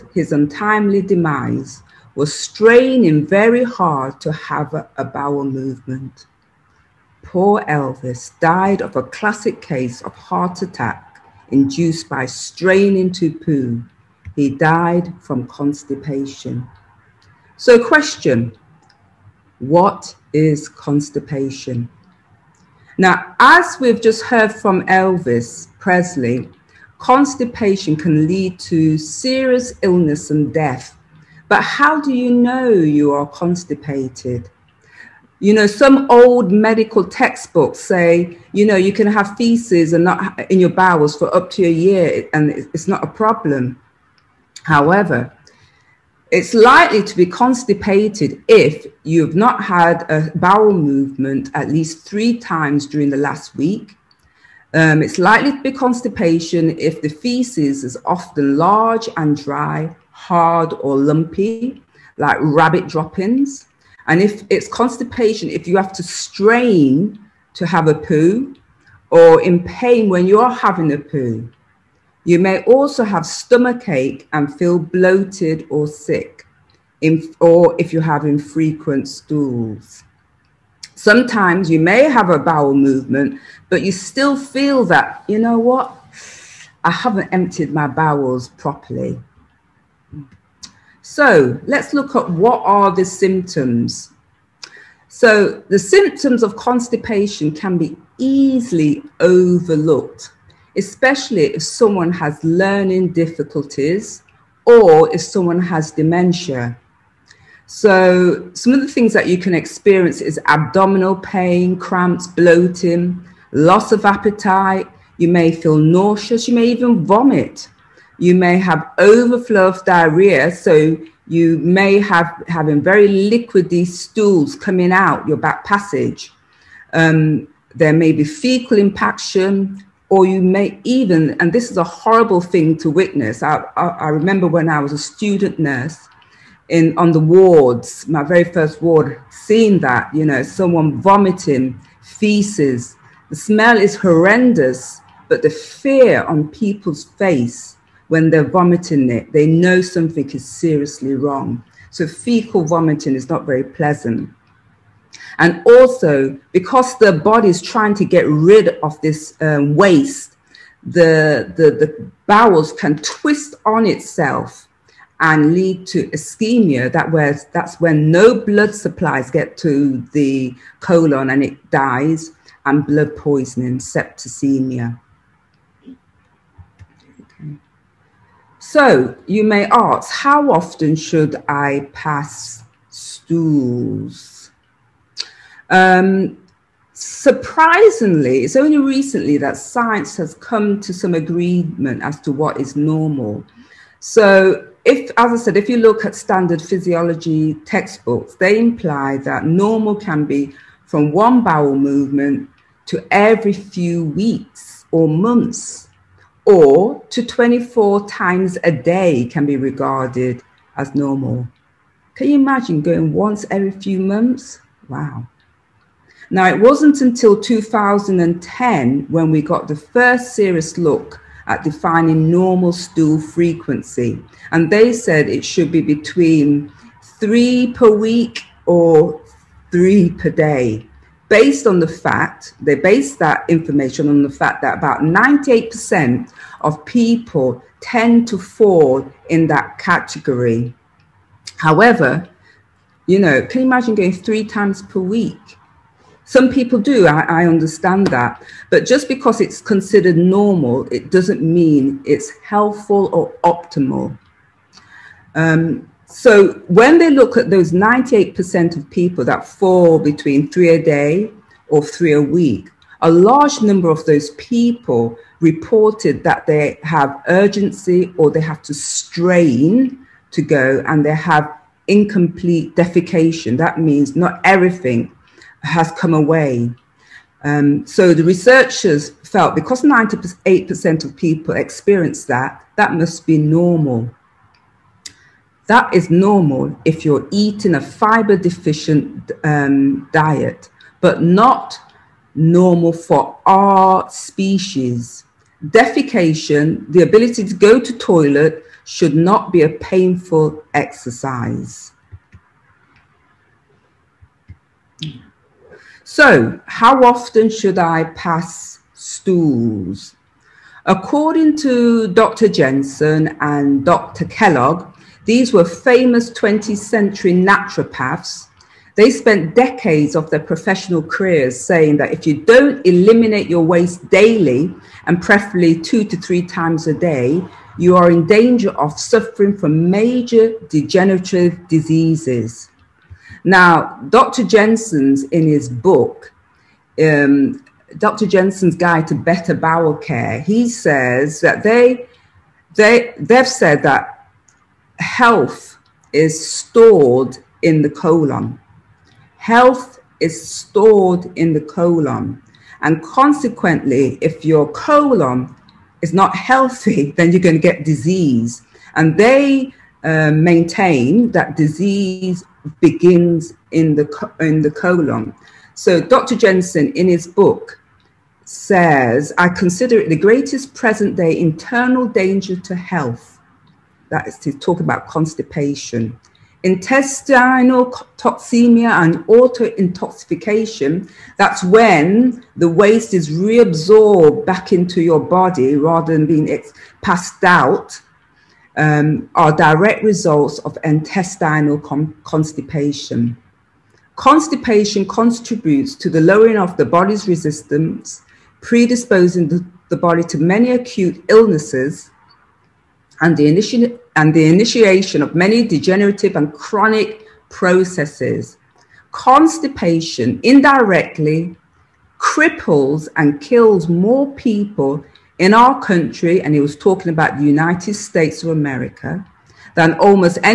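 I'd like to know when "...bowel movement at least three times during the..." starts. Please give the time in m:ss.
0:50.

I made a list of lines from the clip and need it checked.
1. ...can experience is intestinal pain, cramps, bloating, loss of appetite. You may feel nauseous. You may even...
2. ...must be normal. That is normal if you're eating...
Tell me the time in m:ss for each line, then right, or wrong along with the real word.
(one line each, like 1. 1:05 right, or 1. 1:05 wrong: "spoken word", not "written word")
1. 1:49 wrong: "abdominal", not "intestinal"
2. 4:42 right.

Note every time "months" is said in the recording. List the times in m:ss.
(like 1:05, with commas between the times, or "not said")
3:25, 3:33.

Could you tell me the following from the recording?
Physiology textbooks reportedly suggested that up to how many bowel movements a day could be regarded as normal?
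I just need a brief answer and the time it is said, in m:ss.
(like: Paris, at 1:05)
24, at 3:27.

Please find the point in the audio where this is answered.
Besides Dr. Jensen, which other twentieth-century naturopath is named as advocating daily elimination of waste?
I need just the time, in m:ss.
5:13.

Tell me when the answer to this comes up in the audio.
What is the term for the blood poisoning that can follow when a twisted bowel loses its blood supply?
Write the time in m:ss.
2:53.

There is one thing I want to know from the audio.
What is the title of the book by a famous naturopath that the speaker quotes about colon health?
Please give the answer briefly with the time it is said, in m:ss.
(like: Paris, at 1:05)
Dr. Jensen's Guide to Better Bowel Care, at 5:37.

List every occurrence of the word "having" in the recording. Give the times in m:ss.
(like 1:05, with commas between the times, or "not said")
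1:10, 1:18, 2:02.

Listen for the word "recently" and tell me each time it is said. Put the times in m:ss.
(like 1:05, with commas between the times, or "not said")
3:08.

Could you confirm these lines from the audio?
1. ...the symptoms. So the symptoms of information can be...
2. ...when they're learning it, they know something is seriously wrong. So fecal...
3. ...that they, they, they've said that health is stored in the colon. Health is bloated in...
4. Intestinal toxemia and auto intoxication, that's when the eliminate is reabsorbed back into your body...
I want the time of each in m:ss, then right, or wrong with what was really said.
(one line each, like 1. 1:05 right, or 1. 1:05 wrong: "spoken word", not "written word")
1. 1:32 wrong: "constipation", not "information"
2. 2:28 wrong: "vomiting", not "learning"
3. 5:41 wrong: "stored", not "bloated"
4. 6:16 wrong: "waste", not "eliminate".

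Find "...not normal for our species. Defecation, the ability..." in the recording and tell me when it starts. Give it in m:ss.
4:51.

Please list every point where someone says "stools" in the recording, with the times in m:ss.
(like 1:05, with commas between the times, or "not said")
1:19, 2:03, 3:02, 3:42, 5:08.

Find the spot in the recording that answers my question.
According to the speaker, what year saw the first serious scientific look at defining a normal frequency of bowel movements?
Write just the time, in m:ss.
3:37.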